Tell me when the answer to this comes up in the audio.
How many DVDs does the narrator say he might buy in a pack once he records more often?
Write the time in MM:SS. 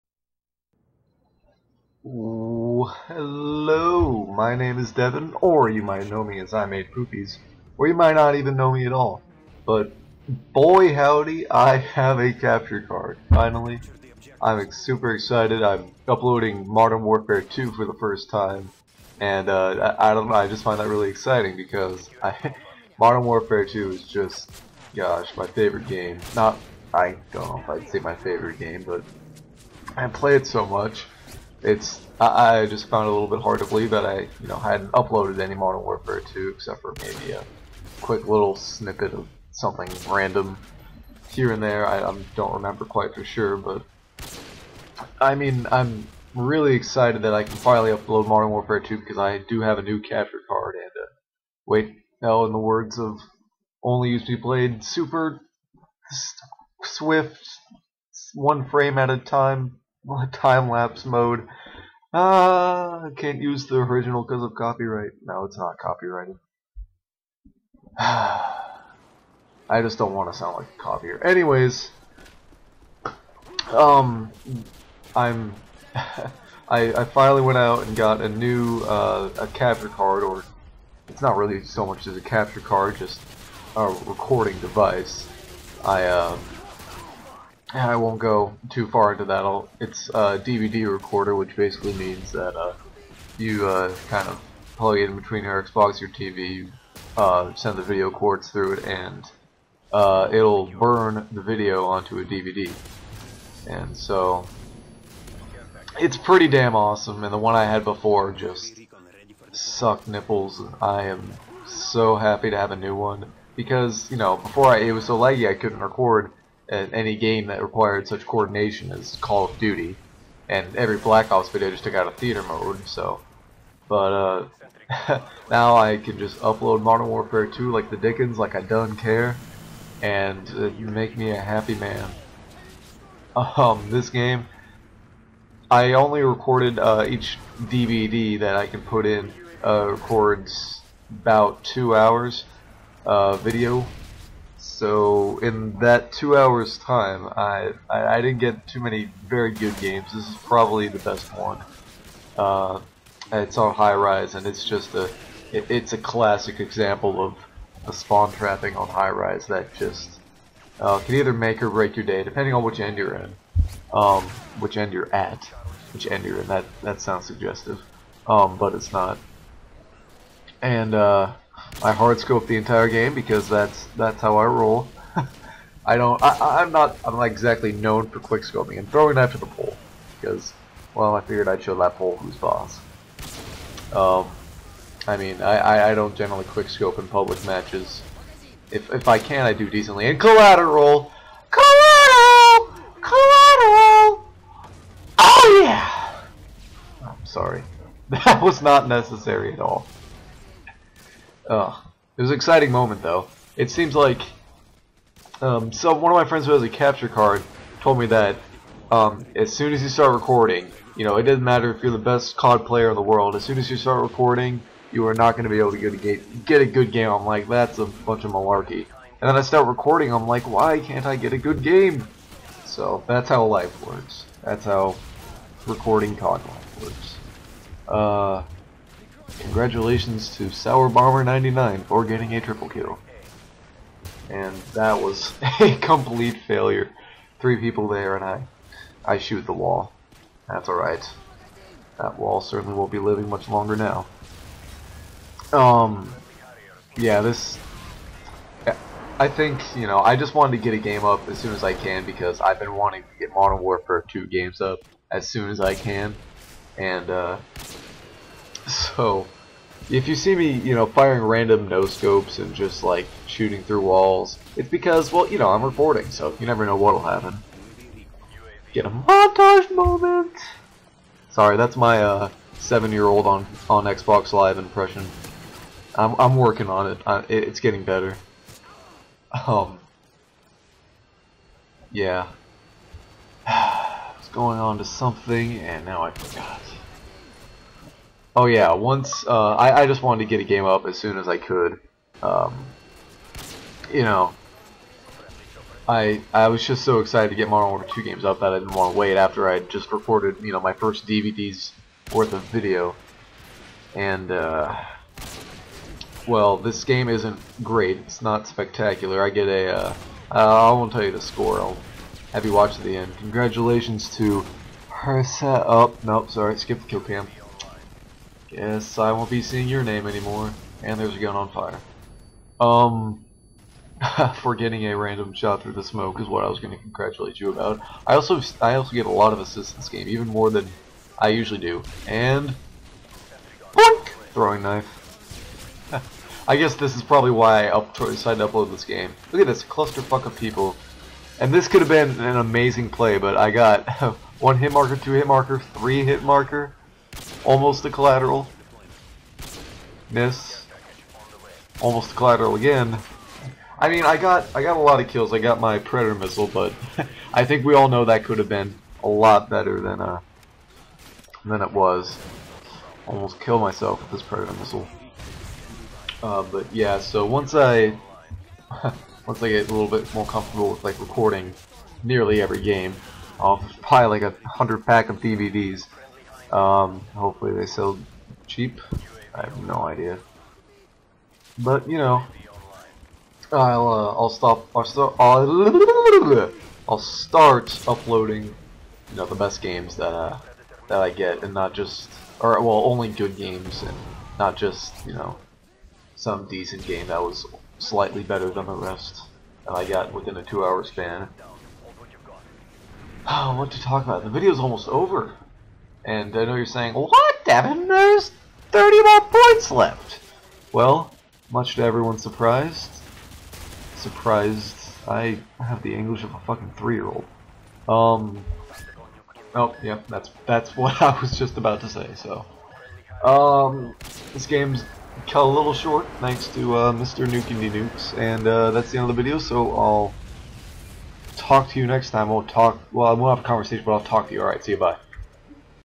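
06:14.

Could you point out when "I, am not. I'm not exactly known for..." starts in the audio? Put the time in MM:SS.
02:56.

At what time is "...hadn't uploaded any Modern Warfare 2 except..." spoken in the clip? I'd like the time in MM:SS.
00:34.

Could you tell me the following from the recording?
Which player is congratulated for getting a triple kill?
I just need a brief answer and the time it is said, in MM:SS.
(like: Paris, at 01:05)
Sour Bomber 99, at 03:50.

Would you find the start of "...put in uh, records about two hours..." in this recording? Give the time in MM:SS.
02:18.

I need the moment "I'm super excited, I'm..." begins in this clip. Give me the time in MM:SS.
00:14.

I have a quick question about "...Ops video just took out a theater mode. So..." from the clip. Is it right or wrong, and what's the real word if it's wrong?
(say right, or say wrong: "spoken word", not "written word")
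right.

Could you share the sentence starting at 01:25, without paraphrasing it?
I, um, uh, I won't go too far into that.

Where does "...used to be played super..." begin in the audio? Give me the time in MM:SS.
00:54.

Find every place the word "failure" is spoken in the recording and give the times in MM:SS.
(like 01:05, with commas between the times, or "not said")
03:56.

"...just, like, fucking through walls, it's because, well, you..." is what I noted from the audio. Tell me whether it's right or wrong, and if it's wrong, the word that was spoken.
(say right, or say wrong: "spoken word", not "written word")
wrong: "shooting", not "fucking".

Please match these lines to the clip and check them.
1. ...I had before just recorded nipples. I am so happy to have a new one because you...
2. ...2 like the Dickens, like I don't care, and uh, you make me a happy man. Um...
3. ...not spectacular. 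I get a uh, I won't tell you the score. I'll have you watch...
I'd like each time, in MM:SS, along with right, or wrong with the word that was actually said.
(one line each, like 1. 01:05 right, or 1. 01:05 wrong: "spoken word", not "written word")
1. 01:47 wrong: "sucked", not "recorded"
2. 02:07 right
3. 05:08 right.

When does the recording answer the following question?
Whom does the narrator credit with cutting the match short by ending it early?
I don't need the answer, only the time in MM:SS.
07:06.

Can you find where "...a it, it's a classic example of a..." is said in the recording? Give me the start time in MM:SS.
02:34.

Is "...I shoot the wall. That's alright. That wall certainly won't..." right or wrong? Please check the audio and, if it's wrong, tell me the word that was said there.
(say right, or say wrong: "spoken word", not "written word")
right.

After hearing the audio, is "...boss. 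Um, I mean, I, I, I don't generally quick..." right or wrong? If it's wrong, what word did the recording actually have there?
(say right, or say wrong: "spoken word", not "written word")
right.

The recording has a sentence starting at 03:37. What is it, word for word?
I'm like, that's a bunch of malarkey.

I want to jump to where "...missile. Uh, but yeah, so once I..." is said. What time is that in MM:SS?
06:04.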